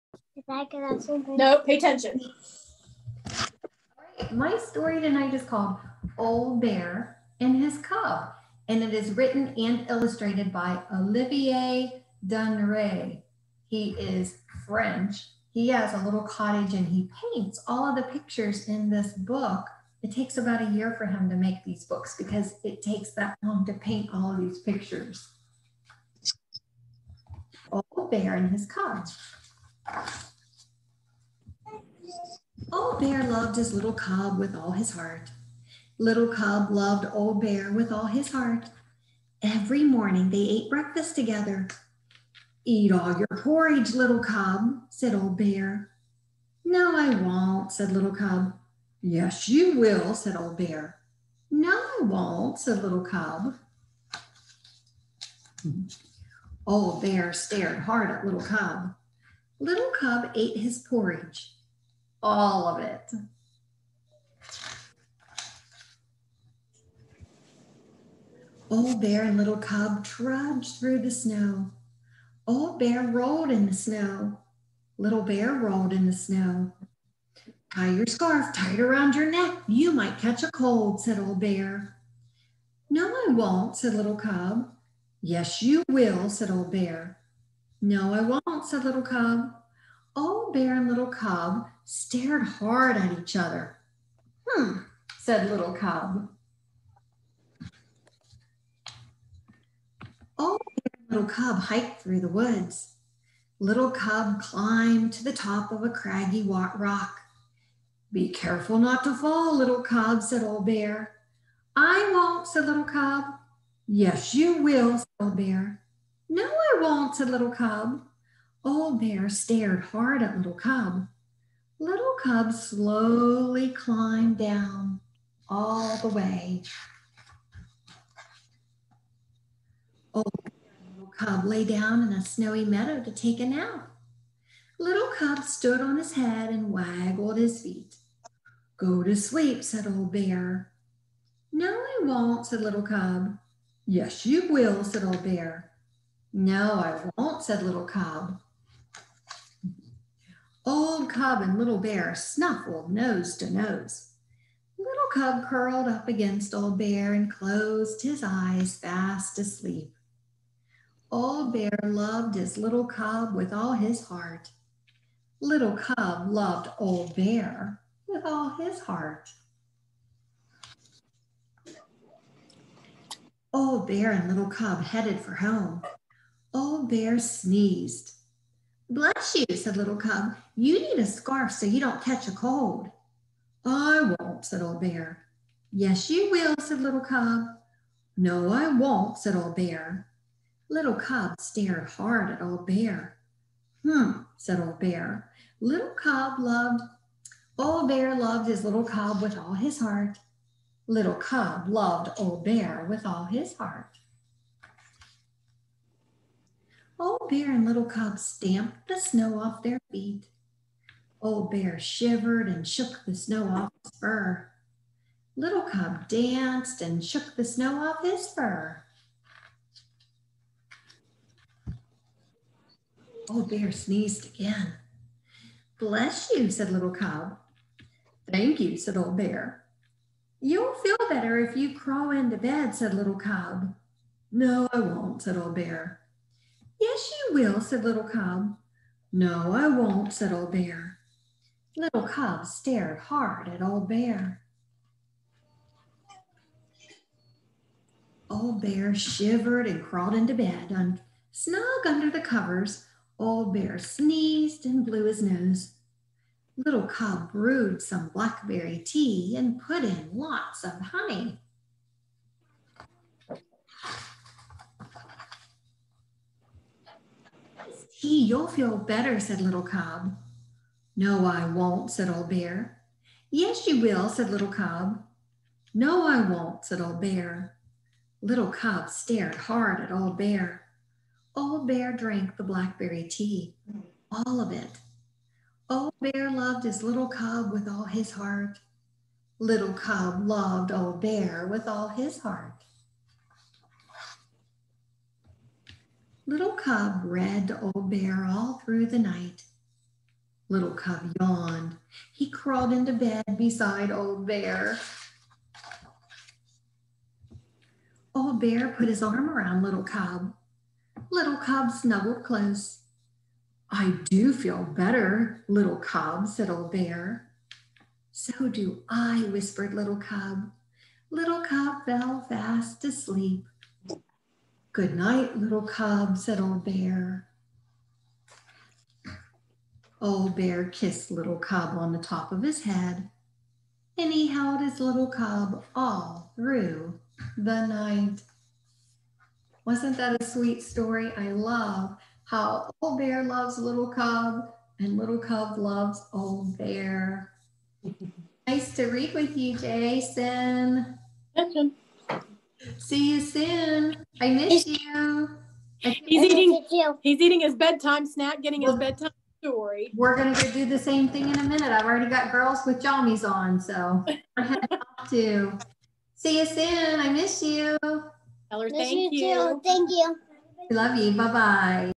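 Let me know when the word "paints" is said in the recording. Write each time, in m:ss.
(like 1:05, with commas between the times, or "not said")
0:17, 0:23.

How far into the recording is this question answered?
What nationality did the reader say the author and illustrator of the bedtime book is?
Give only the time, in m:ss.
0:14.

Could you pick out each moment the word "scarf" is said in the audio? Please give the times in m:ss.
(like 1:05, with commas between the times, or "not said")
1:18, 3:01.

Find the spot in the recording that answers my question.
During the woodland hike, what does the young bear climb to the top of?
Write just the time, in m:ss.
1:45.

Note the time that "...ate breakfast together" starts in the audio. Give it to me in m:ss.
0:40.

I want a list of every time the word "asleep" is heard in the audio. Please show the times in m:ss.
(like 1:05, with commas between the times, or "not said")
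2:39, 5:22.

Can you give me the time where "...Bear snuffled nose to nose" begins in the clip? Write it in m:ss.
2:31.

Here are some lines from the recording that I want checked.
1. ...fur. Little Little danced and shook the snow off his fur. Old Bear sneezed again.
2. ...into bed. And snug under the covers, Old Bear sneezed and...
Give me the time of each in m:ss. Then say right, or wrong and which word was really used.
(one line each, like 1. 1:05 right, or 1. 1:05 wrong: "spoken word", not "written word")
1. 3:33 wrong: "Cub", not "Little"
2. 4:10 right.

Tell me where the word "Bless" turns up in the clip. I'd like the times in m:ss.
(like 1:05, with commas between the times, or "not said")
2:58, 3:45.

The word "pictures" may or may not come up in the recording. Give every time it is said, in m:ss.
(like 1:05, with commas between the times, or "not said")
0:18, 0:24.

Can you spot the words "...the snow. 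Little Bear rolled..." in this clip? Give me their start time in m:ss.
1:13.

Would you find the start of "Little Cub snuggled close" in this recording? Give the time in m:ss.
5:11.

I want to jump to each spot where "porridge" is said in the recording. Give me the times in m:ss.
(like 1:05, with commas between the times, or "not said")
0:43, 1:00.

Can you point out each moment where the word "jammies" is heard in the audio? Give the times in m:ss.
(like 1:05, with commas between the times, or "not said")
6:02.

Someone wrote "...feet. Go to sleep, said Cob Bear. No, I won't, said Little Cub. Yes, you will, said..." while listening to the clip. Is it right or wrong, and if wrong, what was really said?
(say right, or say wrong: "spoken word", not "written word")
wrong: "Old", not "Cob".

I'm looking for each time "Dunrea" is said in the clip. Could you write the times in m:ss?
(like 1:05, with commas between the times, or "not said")
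0:12.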